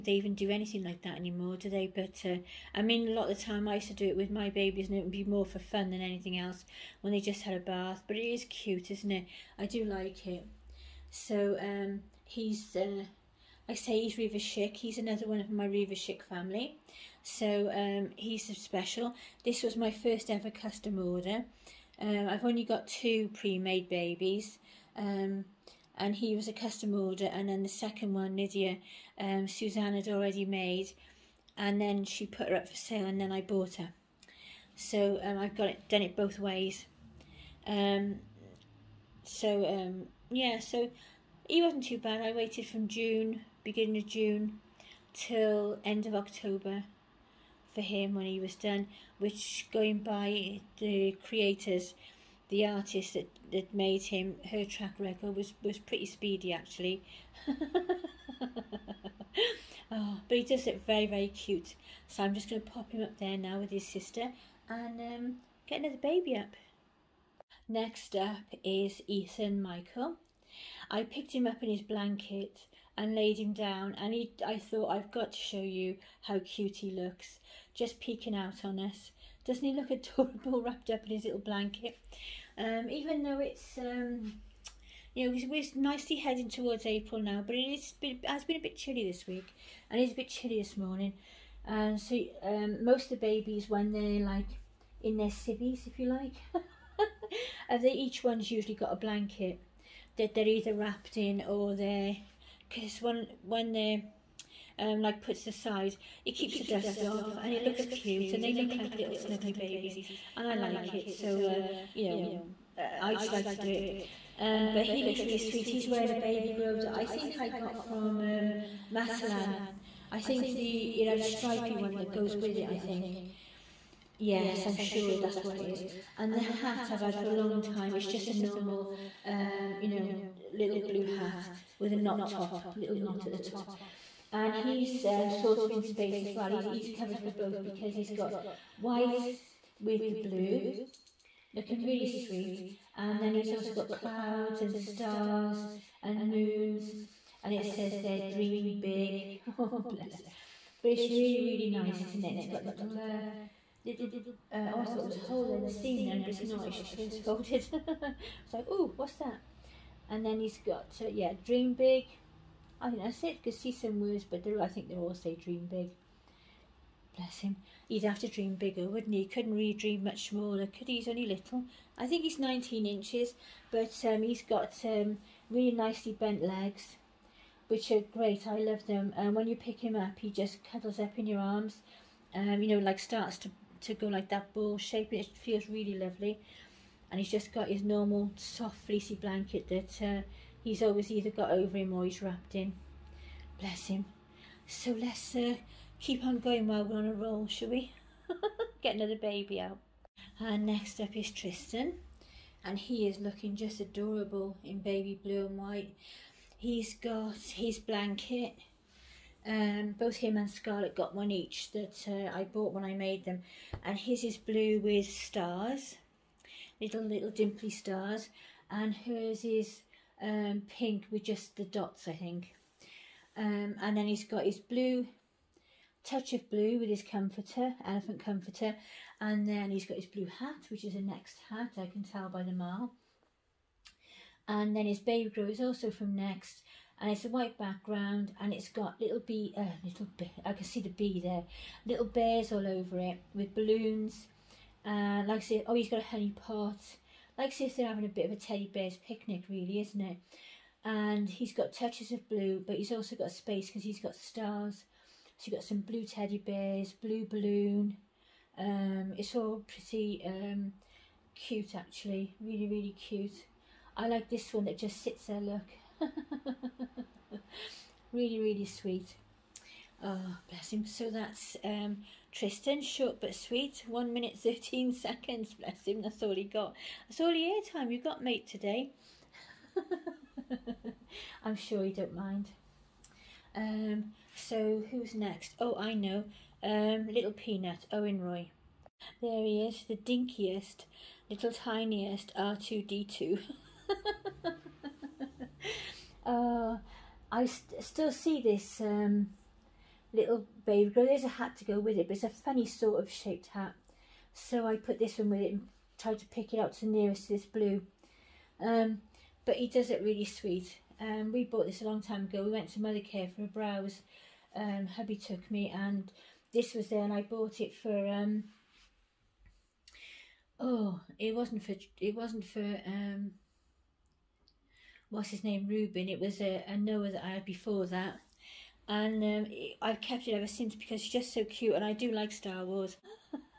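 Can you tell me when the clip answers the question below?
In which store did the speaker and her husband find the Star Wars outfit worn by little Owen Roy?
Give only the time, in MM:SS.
05:12.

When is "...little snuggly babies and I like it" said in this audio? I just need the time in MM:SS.
01:48.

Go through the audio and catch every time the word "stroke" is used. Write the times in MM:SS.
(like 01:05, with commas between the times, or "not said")
not said.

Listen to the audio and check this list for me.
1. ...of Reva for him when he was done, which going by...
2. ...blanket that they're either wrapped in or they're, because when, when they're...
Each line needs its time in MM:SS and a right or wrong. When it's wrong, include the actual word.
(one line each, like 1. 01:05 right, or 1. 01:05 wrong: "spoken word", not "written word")
1. 00:46 wrong: "October", not "Reva"
2. 01:38 right.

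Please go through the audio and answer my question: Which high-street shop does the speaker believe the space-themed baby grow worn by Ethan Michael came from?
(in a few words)
Matalan.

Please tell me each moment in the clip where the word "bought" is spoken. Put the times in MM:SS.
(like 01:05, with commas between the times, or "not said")
00:33, 03:32, 05:11, 05:17.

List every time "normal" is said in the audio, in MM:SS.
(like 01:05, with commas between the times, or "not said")
02:08, 03:07.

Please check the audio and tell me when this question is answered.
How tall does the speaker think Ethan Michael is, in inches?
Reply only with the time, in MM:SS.
02:52.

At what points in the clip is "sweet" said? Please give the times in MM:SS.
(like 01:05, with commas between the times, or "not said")
01:55, 02:22, 04:28, 04:33, 05:10.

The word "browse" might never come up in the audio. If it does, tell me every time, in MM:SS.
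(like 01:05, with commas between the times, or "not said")
05:13.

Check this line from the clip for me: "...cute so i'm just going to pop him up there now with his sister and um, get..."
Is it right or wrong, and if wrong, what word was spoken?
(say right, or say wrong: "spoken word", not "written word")
right.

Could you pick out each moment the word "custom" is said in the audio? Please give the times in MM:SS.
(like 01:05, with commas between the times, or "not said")
00:20, 00:26.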